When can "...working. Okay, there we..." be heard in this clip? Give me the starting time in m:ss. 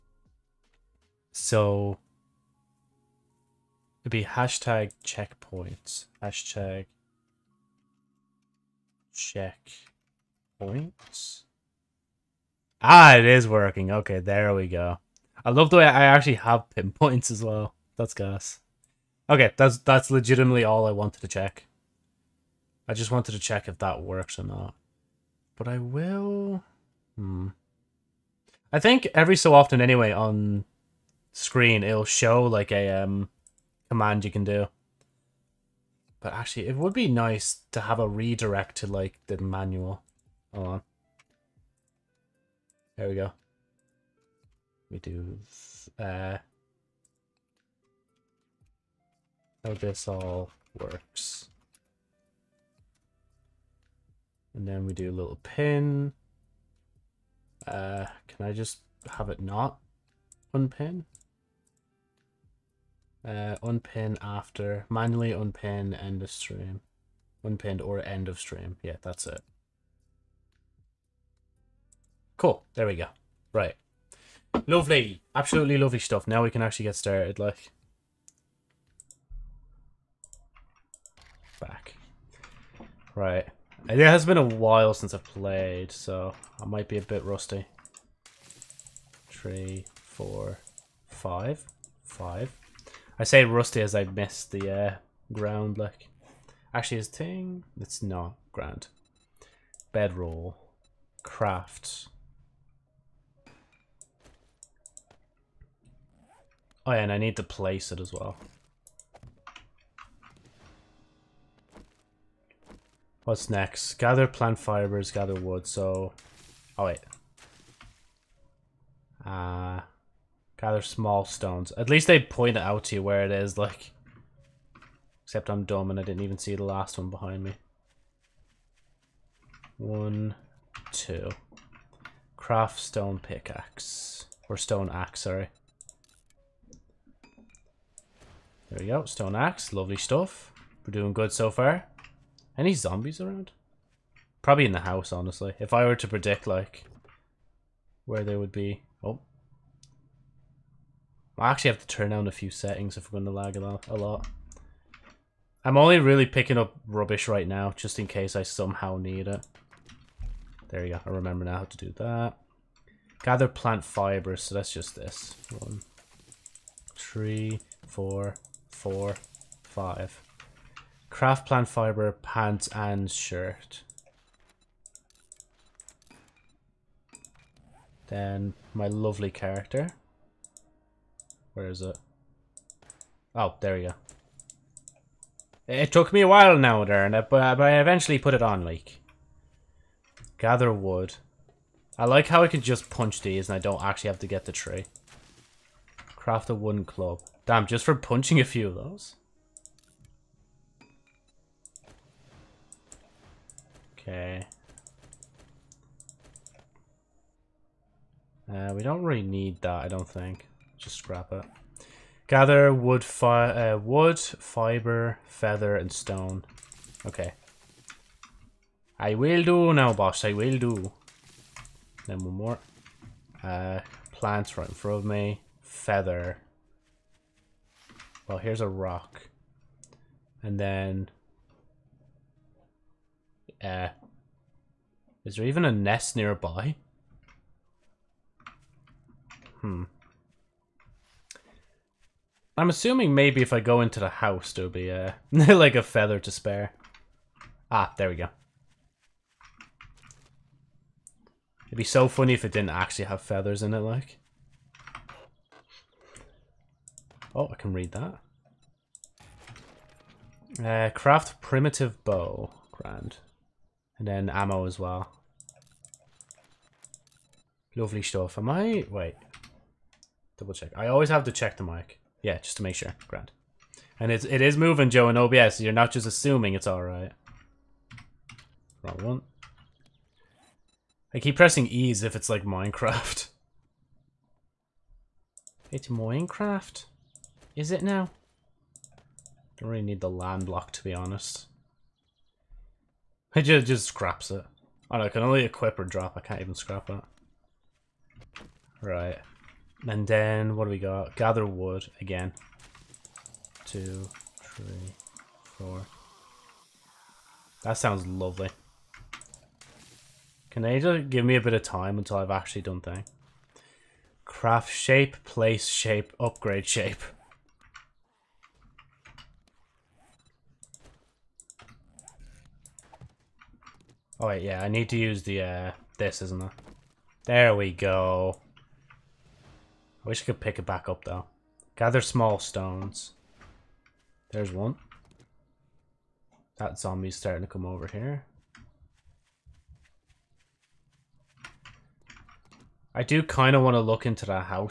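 0:13.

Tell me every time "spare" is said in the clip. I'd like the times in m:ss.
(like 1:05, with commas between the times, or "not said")
4:06.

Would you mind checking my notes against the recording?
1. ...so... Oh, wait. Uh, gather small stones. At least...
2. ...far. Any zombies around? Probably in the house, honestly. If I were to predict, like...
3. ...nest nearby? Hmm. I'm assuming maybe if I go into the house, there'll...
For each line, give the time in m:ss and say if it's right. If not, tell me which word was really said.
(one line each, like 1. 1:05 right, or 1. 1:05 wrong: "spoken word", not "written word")
1. 1:55 right
2. 2:21 right
3. 3:55 right.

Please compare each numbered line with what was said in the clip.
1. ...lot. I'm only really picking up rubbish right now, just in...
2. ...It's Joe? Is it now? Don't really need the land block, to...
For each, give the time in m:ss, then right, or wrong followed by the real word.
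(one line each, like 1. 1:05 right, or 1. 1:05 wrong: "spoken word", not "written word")
1. 2:33 right
2. 4:45 wrong: "Minecraft", not "Joe".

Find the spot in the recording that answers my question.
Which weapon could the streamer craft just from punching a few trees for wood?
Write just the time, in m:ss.
3:16.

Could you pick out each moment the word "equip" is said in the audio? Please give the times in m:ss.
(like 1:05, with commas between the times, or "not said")
4:55.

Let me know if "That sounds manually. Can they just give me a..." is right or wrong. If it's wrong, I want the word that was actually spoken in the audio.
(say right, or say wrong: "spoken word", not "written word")
wrong: "lovely", not "manually".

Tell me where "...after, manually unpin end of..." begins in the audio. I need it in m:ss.
1:04.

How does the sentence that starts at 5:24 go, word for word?
Oh wait, yeah, I need to use the uh, this, isn't it?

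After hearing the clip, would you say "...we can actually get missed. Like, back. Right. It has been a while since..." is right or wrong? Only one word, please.
wrong.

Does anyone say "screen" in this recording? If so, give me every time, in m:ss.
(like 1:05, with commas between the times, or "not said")
0:31.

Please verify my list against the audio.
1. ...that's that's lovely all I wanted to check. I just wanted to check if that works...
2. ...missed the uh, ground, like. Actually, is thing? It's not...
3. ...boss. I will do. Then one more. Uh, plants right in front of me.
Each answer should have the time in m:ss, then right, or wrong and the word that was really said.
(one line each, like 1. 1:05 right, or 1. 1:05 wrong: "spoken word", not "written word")
1. 0:19 wrong: "legitimately", not "lovely"
2. 1:34 right
3. 3:39 right.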